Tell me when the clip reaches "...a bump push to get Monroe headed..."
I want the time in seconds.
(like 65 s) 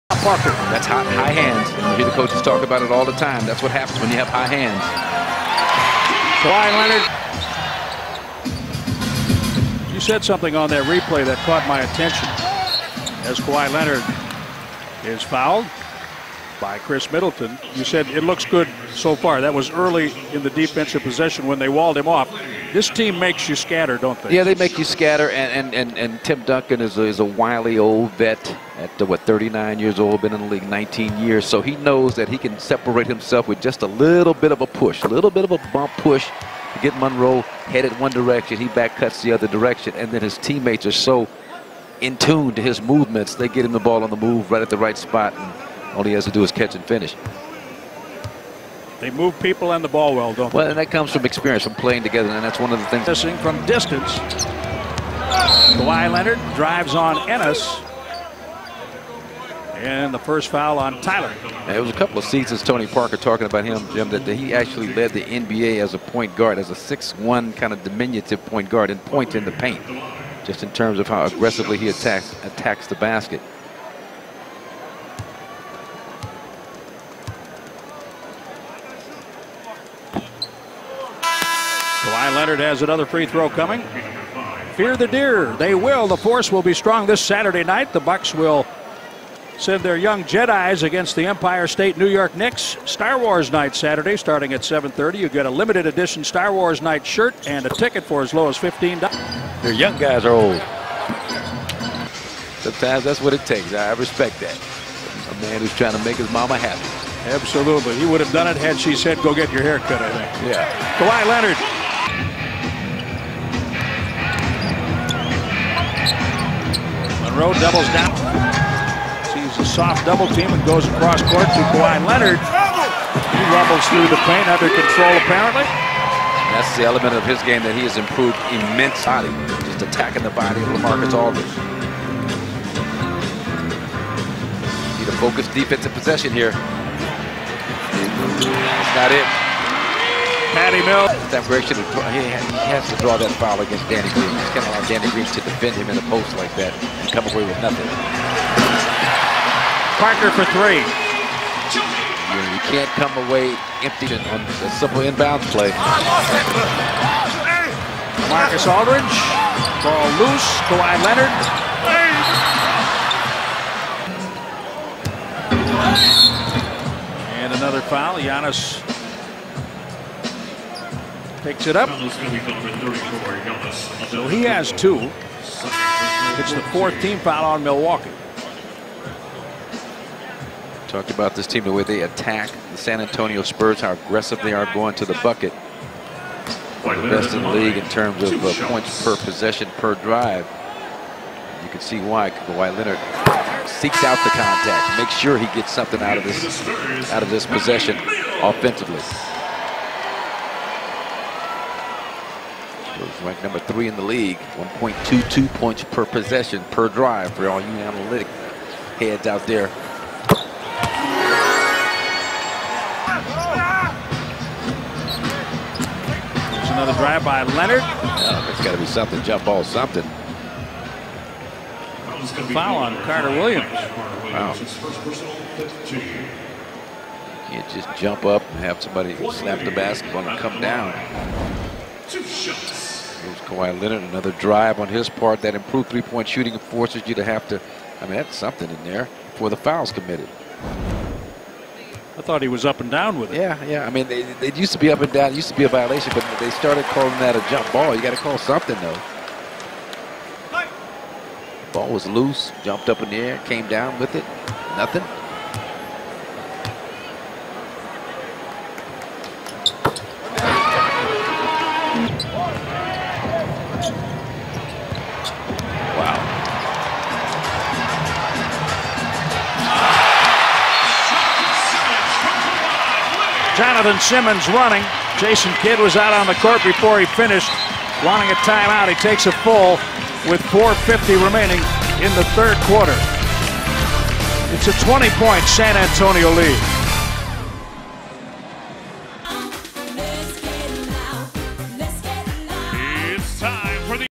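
35 s.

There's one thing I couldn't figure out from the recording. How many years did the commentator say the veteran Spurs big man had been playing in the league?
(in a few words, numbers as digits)
19.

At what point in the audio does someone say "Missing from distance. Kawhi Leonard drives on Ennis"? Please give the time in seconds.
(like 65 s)
53 s.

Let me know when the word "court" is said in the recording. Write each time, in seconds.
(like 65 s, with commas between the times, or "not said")
121 s, 276 s.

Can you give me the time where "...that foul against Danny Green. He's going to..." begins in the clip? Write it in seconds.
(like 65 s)
143 s.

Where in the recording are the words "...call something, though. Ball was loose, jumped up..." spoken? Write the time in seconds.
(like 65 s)
248 s.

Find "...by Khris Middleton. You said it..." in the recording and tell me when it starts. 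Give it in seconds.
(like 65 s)
16 s.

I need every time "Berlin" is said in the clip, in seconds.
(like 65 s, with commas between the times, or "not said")
not said.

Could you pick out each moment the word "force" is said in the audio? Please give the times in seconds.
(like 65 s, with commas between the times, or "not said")
86 s, 236 s.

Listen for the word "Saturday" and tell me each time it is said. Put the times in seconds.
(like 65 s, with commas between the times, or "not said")
87 s, 93 s.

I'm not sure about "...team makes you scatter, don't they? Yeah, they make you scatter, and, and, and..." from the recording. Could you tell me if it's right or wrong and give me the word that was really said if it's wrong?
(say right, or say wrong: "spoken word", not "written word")
right.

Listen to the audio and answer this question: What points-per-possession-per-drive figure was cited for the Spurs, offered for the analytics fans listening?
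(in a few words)
1.22.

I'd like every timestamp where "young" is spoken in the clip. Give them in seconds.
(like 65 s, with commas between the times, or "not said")
89 s, 99 s.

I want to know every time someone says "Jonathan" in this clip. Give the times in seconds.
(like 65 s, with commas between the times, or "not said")
273 s.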